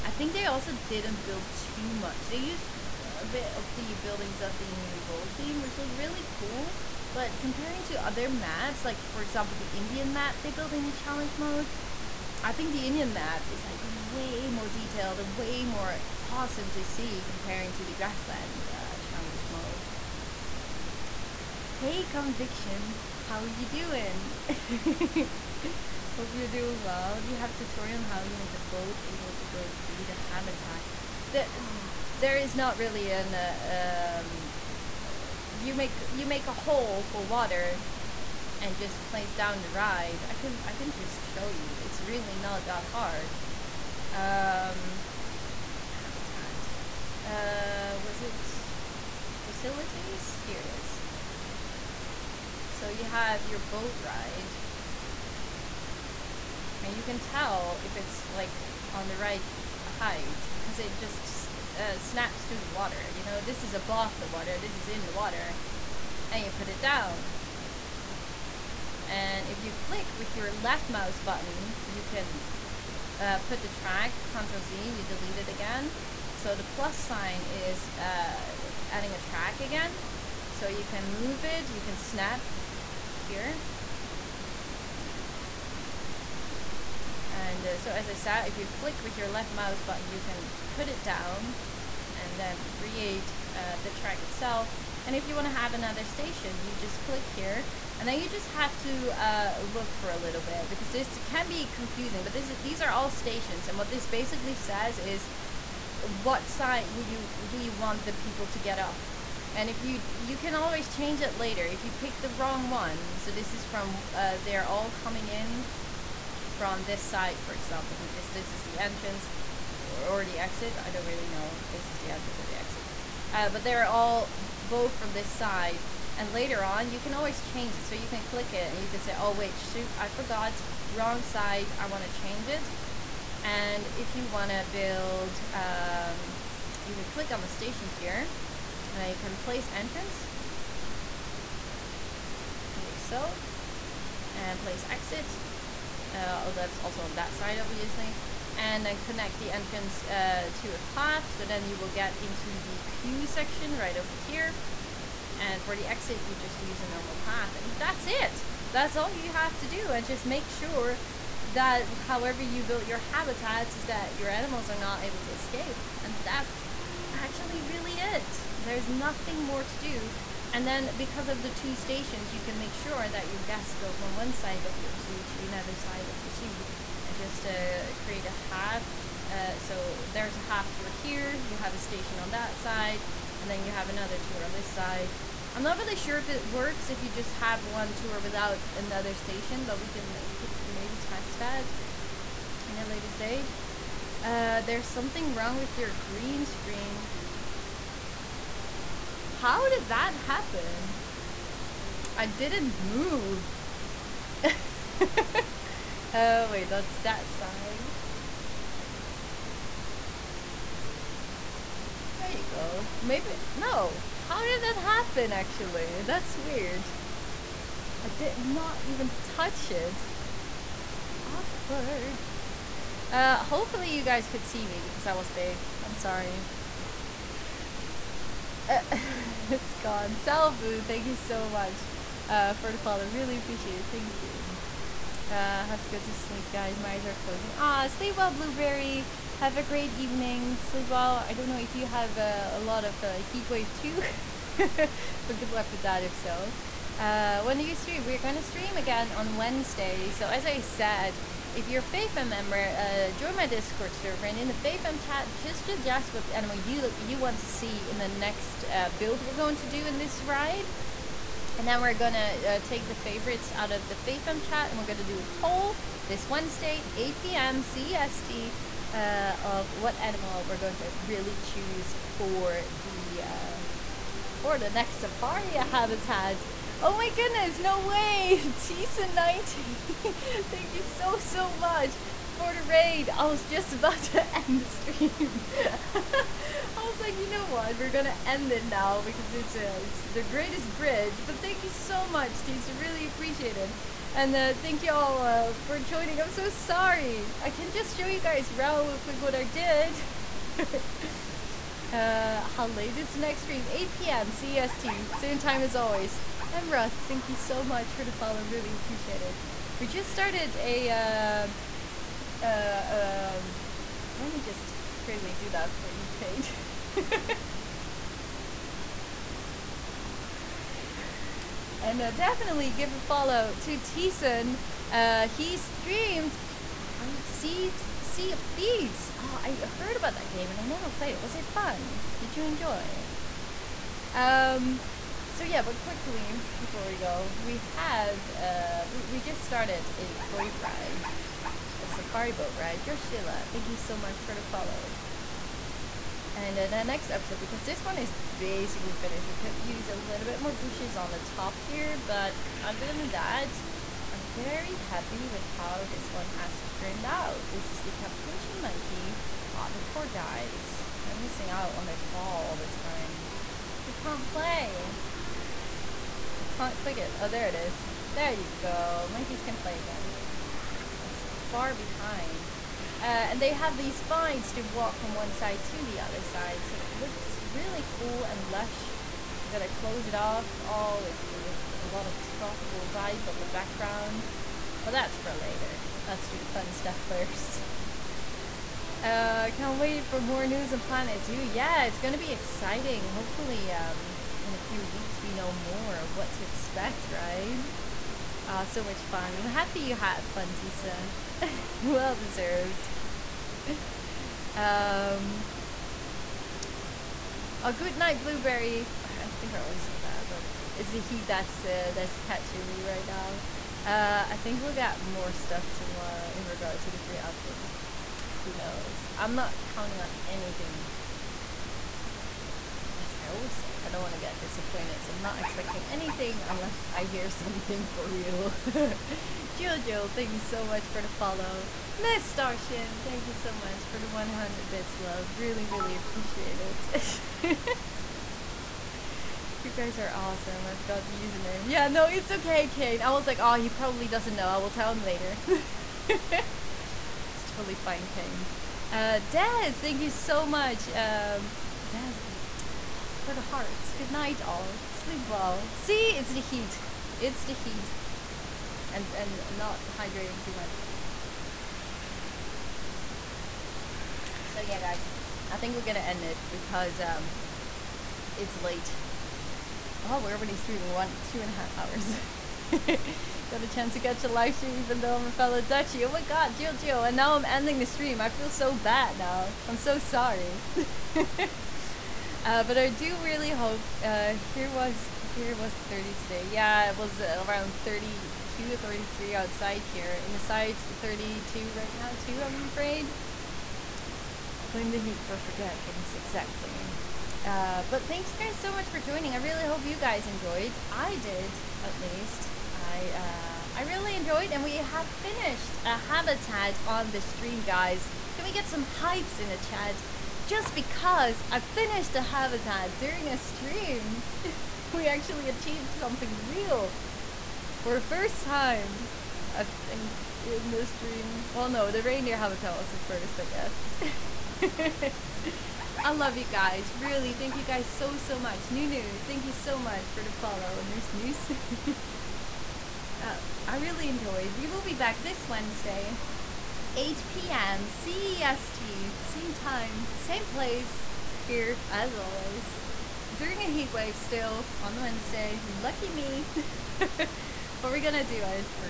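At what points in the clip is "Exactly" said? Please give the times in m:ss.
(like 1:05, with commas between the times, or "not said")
8:16.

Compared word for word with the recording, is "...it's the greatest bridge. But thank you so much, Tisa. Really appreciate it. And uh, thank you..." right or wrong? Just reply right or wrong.
right.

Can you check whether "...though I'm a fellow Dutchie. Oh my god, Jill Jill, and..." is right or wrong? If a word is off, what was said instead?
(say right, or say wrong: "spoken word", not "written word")
right.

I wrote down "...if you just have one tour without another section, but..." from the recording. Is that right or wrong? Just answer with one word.
wrong.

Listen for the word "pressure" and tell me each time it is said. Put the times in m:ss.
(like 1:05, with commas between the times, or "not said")
not said.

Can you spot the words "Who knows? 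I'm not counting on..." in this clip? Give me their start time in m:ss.
6:58.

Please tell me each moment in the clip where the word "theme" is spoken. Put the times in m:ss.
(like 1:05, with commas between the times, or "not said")
0:05.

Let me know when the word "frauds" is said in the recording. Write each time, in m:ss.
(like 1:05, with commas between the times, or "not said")
not said.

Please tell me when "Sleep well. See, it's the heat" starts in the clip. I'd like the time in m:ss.
7:34.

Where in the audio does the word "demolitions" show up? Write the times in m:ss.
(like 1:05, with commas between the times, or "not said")
not said.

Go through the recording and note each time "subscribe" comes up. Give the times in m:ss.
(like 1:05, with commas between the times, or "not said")
not said.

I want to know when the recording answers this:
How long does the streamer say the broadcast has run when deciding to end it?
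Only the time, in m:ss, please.
7:51.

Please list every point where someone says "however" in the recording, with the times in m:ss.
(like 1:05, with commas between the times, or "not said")
2:42.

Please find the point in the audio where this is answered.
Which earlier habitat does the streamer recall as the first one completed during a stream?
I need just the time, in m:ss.
8:42.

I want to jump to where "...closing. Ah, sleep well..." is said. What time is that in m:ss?
3:57.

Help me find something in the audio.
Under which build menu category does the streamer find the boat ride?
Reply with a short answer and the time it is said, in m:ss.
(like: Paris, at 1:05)
Facilities, at 0:49.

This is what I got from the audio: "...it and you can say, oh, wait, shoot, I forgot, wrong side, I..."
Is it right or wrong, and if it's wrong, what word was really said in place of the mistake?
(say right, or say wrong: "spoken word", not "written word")
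right.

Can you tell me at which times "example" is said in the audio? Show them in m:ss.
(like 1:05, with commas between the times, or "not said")
0:09, 1:57.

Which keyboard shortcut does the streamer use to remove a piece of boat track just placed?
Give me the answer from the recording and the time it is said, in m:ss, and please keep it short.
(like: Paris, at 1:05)
Control Z, at 1:14.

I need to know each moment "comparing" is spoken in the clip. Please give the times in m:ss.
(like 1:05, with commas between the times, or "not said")
0:07, 0:17.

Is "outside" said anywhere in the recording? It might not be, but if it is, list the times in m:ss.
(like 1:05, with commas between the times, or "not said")
8:09.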